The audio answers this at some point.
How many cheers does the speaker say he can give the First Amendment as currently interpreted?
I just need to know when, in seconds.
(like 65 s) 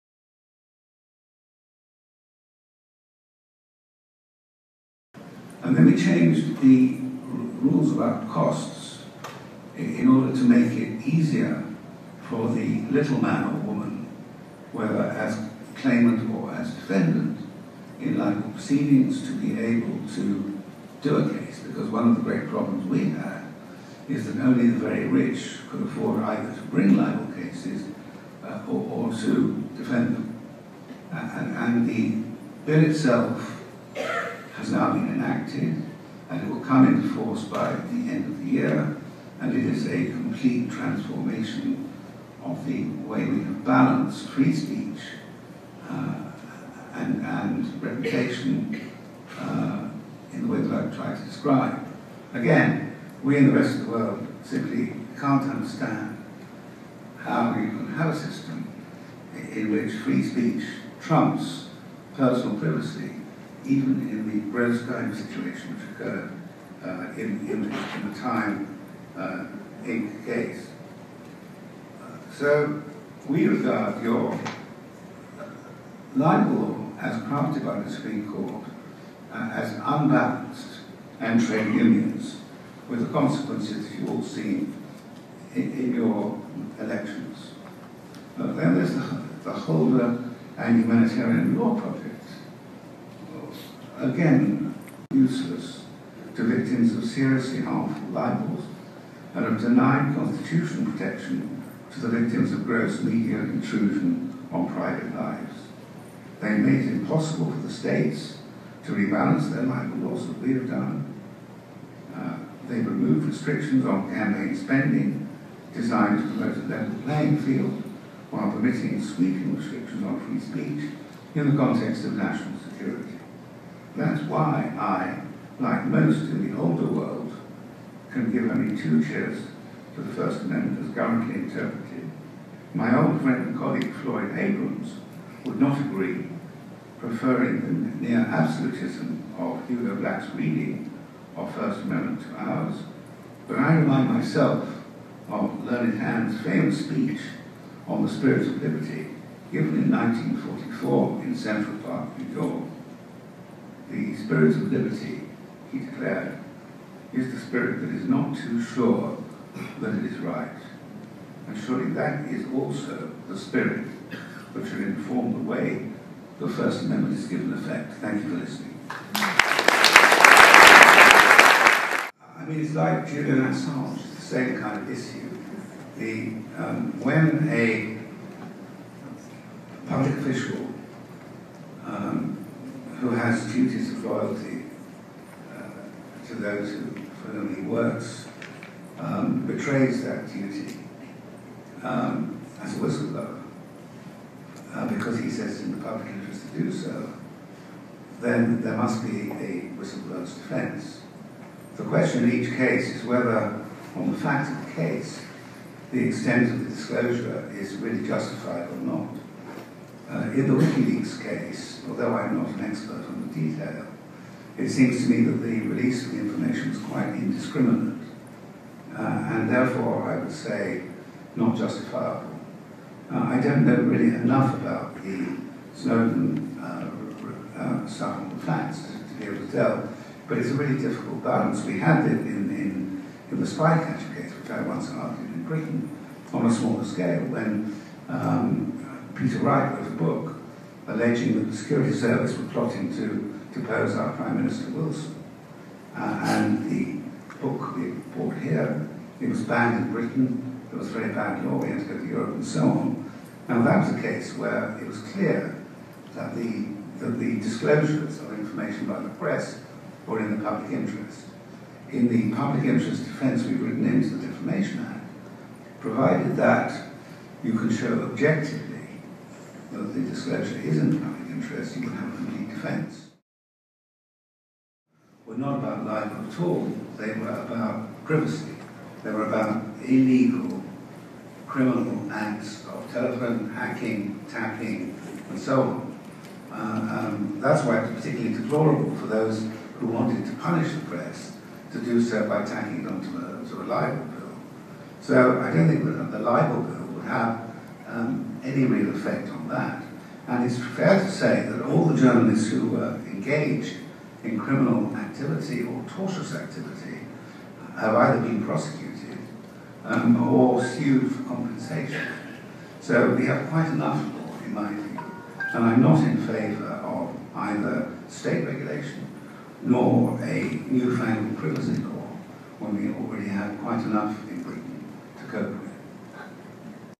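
128 s.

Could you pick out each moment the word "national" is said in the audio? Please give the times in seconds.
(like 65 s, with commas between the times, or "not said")
122 s.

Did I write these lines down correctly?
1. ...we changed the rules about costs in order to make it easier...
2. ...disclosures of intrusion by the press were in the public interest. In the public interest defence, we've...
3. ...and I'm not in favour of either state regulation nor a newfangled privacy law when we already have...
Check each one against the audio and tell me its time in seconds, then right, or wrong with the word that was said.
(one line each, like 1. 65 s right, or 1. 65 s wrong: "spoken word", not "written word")
1. 5 s right
2. 257 s wrong: "information", not "intrusion"
3. 315 s right.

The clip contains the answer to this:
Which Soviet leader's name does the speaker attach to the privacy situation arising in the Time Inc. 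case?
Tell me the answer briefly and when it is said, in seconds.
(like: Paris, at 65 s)
Brezhnev, at 64 s.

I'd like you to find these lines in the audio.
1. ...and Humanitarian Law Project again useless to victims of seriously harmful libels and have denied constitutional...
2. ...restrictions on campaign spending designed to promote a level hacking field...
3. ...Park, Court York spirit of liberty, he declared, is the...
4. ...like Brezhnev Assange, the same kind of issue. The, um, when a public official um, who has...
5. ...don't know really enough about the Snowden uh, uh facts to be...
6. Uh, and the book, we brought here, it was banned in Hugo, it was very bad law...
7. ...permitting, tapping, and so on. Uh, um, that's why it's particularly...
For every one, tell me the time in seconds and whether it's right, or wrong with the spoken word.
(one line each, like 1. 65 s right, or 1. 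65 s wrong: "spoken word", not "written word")
1. 90 s right
2. 113 s wrong: "playing", not "hacking"
3. 151 s wrong: "New", not "Court"
4. 172 s wrong: "Julian", not "Brezhnev"
5. 223 s right
6. 245 s wrong: "Britain", not "Hugo"
7. 283 s wrong: "hacking", not "permitting".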